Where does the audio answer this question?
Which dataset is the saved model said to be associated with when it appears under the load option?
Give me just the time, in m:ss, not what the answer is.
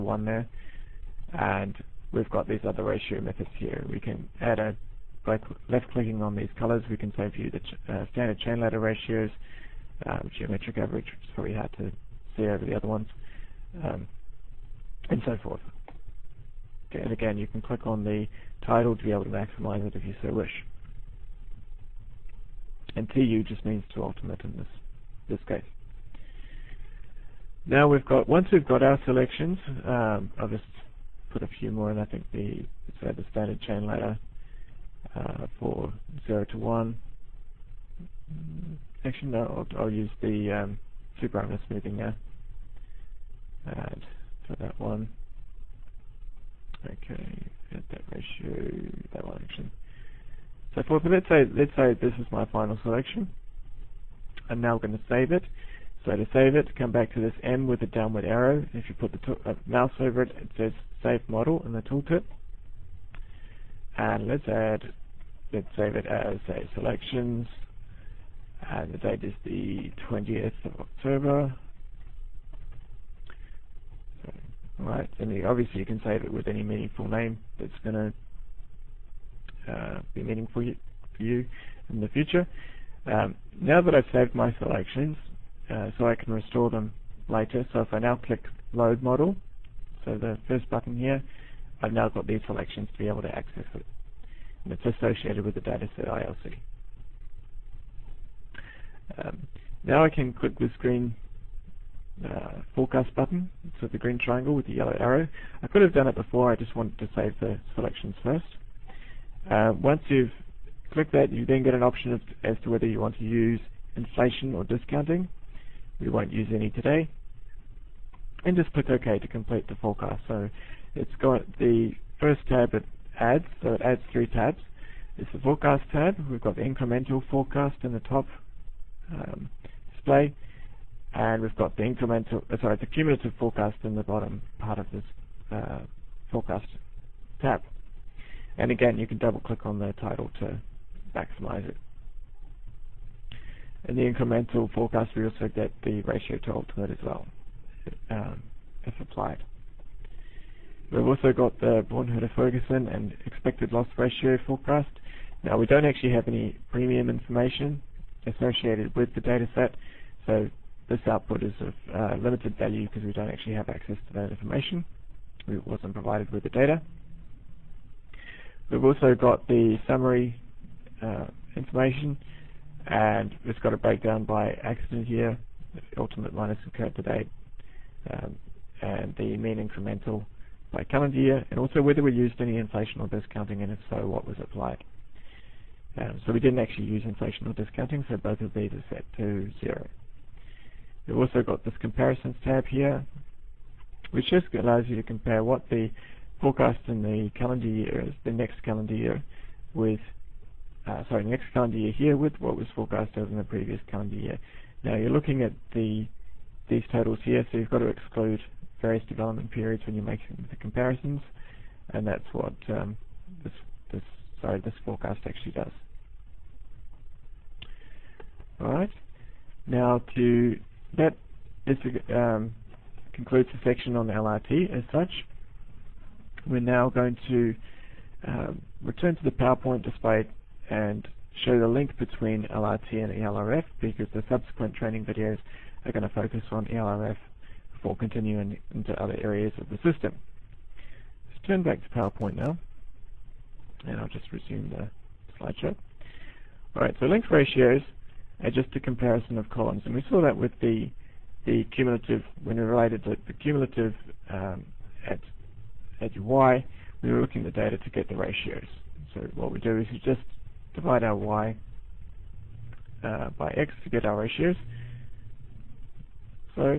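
1:34.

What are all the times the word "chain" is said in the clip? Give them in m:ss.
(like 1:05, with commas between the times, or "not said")
0:08, 0:33.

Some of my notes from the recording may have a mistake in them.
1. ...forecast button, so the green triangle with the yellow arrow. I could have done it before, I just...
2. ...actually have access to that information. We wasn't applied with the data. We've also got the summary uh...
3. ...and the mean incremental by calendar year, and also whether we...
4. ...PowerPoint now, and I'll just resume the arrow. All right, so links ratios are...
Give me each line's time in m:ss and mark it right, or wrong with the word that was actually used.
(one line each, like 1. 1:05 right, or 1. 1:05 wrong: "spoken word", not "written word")
1. 1:42 right
2. 2:43 wrong: "provided", not "applied"
3. 2:58 right
4. 4:01 wrong: "slideshow", not "arrow".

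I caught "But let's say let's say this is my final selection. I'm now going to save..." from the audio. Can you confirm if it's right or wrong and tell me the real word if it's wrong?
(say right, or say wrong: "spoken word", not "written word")
right.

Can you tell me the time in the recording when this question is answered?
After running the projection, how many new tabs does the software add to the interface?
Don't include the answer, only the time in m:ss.
2:03.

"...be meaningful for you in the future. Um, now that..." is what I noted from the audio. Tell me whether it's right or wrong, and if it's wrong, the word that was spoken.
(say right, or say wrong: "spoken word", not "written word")
right.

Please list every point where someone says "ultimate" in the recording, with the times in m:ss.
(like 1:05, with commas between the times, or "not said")
0:24, 2:55.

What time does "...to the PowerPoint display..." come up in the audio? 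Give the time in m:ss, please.
3:49.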